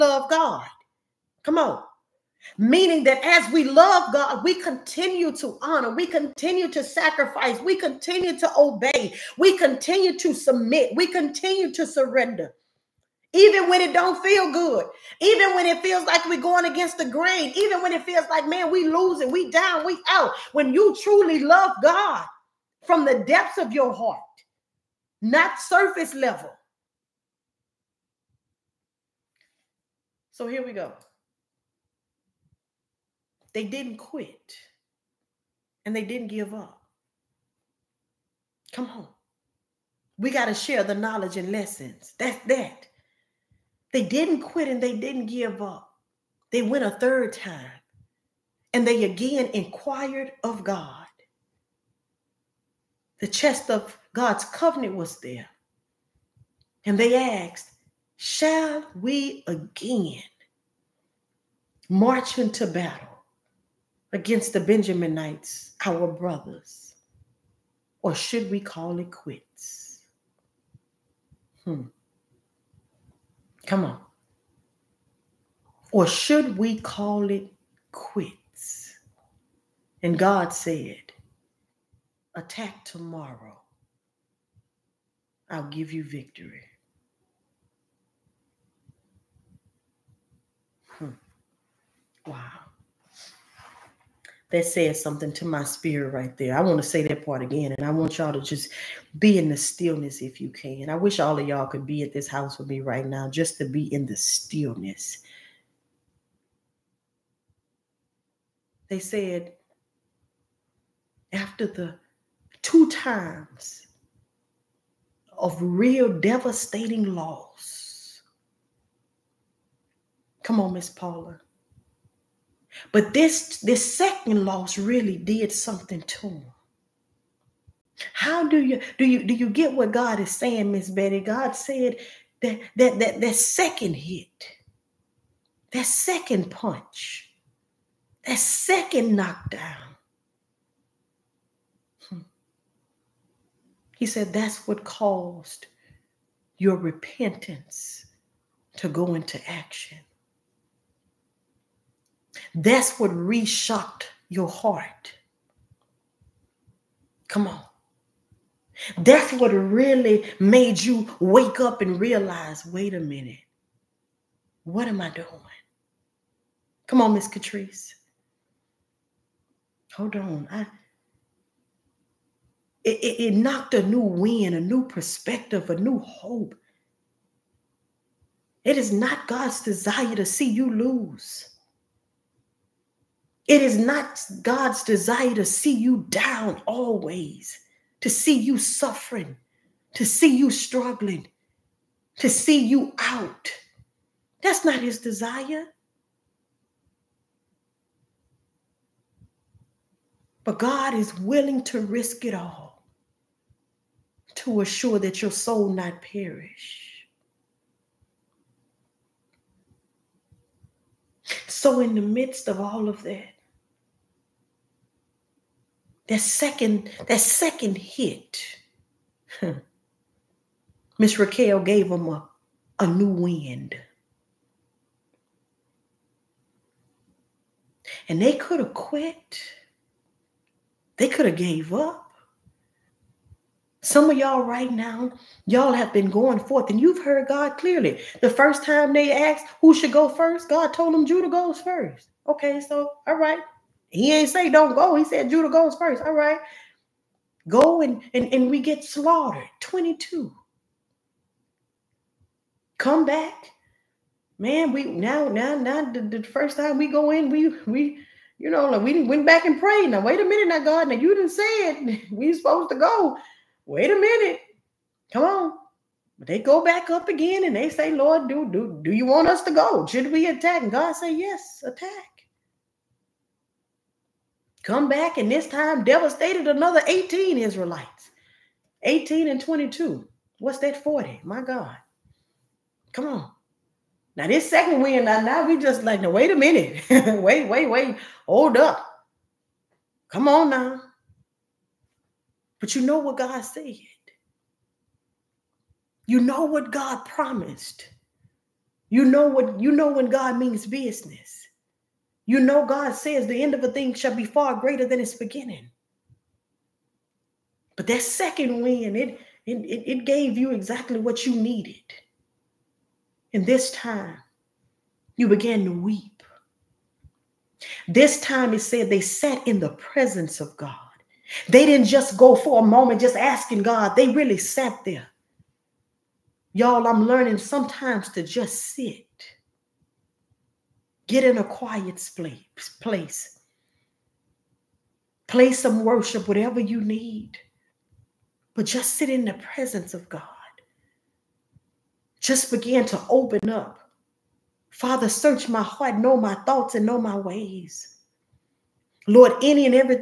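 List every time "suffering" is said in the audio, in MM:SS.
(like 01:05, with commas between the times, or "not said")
03:08.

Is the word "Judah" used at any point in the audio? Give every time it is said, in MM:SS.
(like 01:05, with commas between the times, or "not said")
04:01, 04:05.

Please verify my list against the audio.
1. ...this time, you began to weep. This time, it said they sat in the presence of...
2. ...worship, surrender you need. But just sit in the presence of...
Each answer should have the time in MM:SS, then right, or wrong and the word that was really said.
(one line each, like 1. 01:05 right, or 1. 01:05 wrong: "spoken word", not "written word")
1. 05:13 right
2. 05:35 wrong: "whatever", not "surrender".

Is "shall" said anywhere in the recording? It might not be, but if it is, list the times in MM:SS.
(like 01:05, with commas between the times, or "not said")
00:58, 05:03.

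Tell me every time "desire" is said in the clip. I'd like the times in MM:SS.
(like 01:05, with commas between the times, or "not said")
02:59, 03:04, 03:14.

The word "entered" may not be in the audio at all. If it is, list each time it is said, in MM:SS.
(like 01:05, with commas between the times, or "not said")
not said.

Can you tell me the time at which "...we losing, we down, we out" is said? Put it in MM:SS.
00:18.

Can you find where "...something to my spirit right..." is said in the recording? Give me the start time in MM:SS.
01:35.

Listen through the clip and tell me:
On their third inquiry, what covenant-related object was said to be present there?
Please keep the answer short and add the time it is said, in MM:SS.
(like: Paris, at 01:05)
The chest, at 00:53.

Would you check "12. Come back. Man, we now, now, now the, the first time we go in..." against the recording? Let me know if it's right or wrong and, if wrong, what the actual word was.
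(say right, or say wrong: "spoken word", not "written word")
wrong: "22", not "12".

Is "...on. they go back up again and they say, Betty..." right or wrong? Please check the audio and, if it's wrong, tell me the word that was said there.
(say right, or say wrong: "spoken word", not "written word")
wrong: "Lord", not "Betty".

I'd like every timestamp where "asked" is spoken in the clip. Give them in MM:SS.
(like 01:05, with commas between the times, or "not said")
00:57, 03:59.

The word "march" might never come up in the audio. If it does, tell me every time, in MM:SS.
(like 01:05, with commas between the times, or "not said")
01:01.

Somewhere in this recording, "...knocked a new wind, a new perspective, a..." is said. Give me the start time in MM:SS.
02:53.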